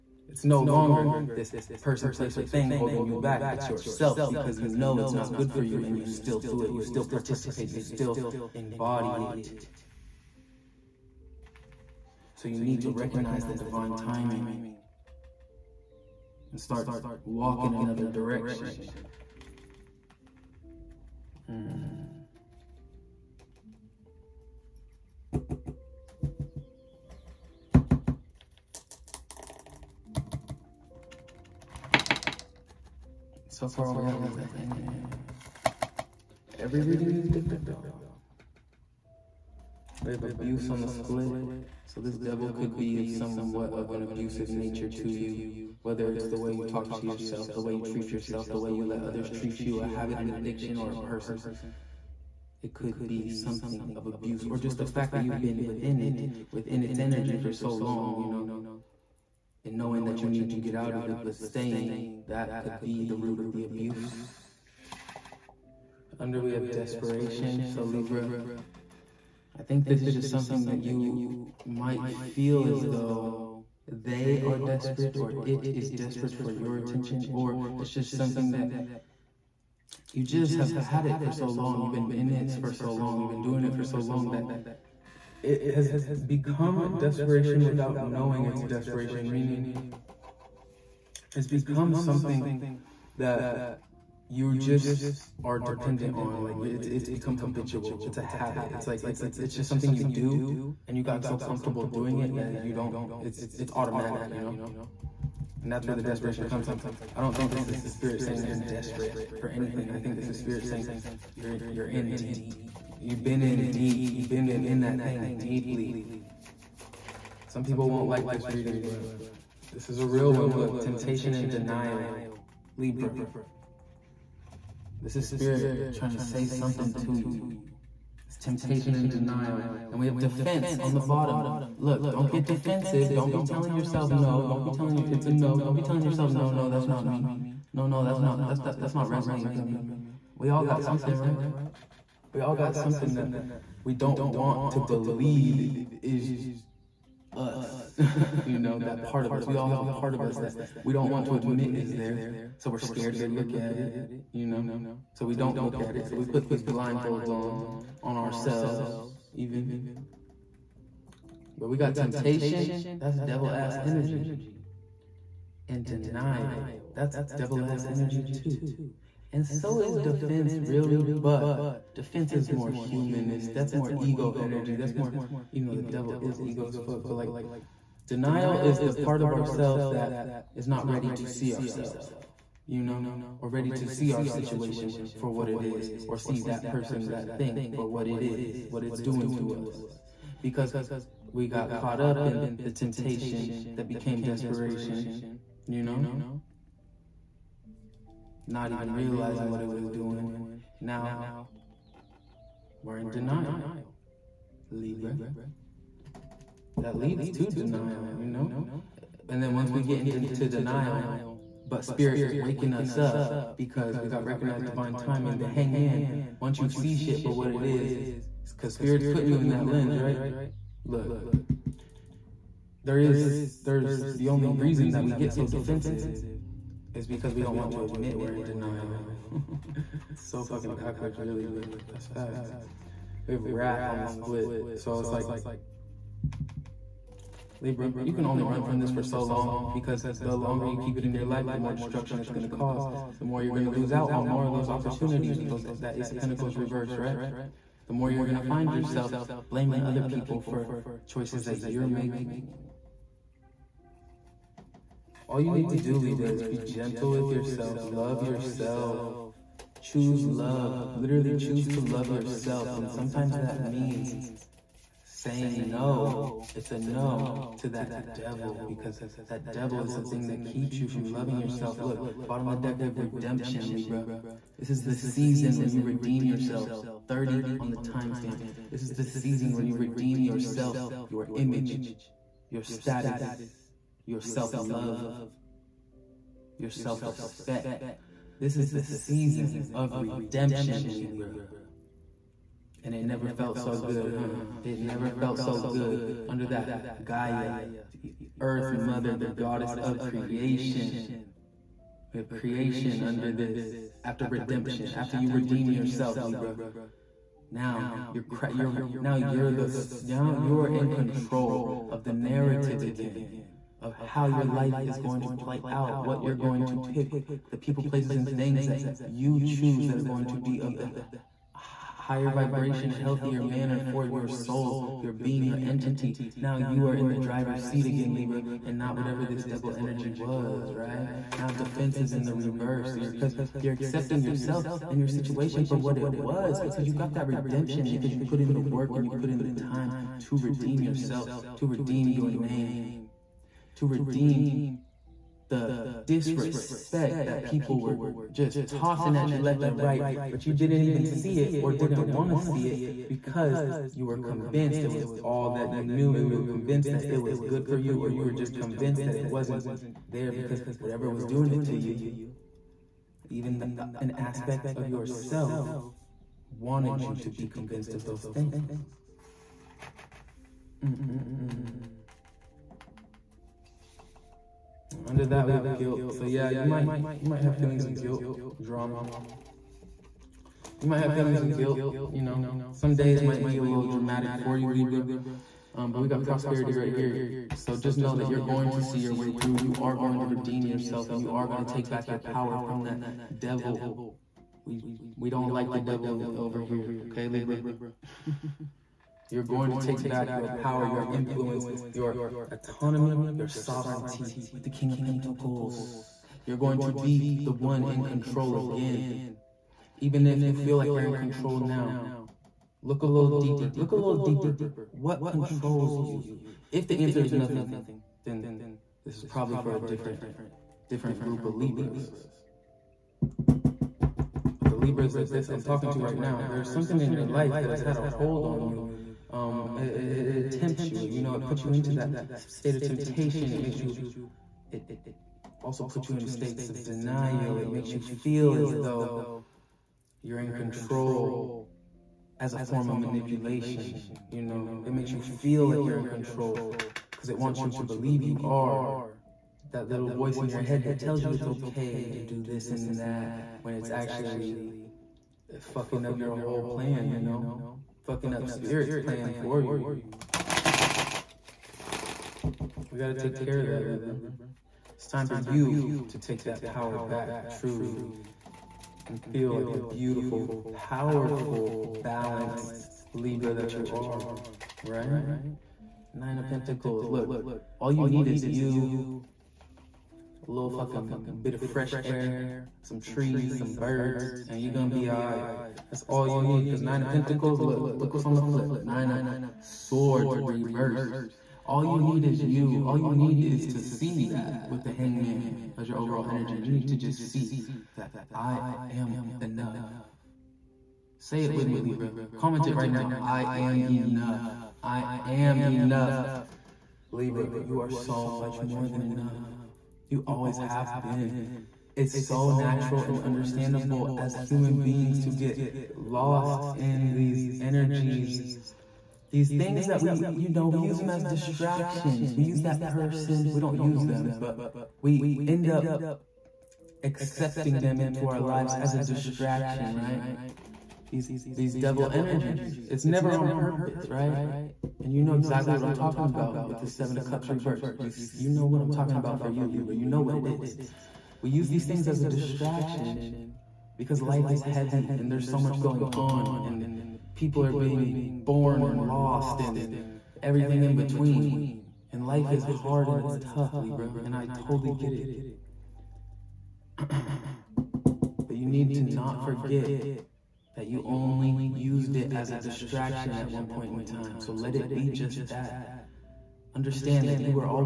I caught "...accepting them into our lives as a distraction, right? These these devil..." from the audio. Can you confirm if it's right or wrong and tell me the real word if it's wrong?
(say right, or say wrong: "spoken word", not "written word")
right.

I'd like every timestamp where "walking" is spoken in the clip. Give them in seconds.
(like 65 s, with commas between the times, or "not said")
17 s.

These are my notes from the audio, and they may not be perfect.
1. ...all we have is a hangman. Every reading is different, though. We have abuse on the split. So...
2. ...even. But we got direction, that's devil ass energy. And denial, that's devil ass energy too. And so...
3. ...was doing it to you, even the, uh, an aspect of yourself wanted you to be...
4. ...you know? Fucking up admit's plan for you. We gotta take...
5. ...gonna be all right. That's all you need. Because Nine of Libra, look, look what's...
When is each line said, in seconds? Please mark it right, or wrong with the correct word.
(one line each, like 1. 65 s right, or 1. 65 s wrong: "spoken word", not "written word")
1. 33 s right
2. 159 s wrong: "temptation", not "direction"
3. 361 s right
4. 457 s wrong: "spirit", not "admit"
5. 484 s wrong: "Pentacles", not "Libra".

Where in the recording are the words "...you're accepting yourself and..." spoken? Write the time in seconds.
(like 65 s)
333 s.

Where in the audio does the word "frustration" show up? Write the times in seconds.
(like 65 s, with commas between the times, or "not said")
not said.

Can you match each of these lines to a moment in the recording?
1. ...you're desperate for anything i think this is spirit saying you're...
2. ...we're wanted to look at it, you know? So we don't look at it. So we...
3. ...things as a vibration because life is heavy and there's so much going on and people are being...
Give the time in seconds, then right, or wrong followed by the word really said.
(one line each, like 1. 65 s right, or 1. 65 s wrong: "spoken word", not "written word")
1. 108 s right
2. 152 s wrong: "scared", not "wanted"
3. 541 s wrong: "distraction", not "vibration".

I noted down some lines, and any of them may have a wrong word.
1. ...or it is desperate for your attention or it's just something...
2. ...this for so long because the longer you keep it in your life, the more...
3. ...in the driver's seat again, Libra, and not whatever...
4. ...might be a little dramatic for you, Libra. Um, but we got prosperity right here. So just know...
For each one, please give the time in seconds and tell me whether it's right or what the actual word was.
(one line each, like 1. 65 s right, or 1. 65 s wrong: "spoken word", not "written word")
1. 75 s right
2. 238 s right
3. 326 s right
4. 383 s right.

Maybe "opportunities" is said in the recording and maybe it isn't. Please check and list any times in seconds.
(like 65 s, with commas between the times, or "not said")
244 s.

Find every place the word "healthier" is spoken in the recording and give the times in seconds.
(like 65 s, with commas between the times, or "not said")
322 s.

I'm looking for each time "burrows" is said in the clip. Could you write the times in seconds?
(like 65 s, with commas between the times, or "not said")
not said.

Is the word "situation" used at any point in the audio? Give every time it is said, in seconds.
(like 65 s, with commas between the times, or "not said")
184 s, 335 s.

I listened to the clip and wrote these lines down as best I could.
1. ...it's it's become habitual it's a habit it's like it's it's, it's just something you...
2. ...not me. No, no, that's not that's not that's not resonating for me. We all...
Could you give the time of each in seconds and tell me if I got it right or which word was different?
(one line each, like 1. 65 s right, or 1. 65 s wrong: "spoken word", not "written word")
1. 96 s right
2. 136 s right.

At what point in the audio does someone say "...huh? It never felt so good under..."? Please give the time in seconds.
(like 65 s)
294 s.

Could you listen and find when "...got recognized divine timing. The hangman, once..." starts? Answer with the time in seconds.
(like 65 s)
214 s.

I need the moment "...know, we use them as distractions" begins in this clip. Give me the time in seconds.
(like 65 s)
520 s.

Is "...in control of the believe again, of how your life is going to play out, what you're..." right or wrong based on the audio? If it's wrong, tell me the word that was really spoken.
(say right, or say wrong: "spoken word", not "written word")
wrong: "narrative", not "believe".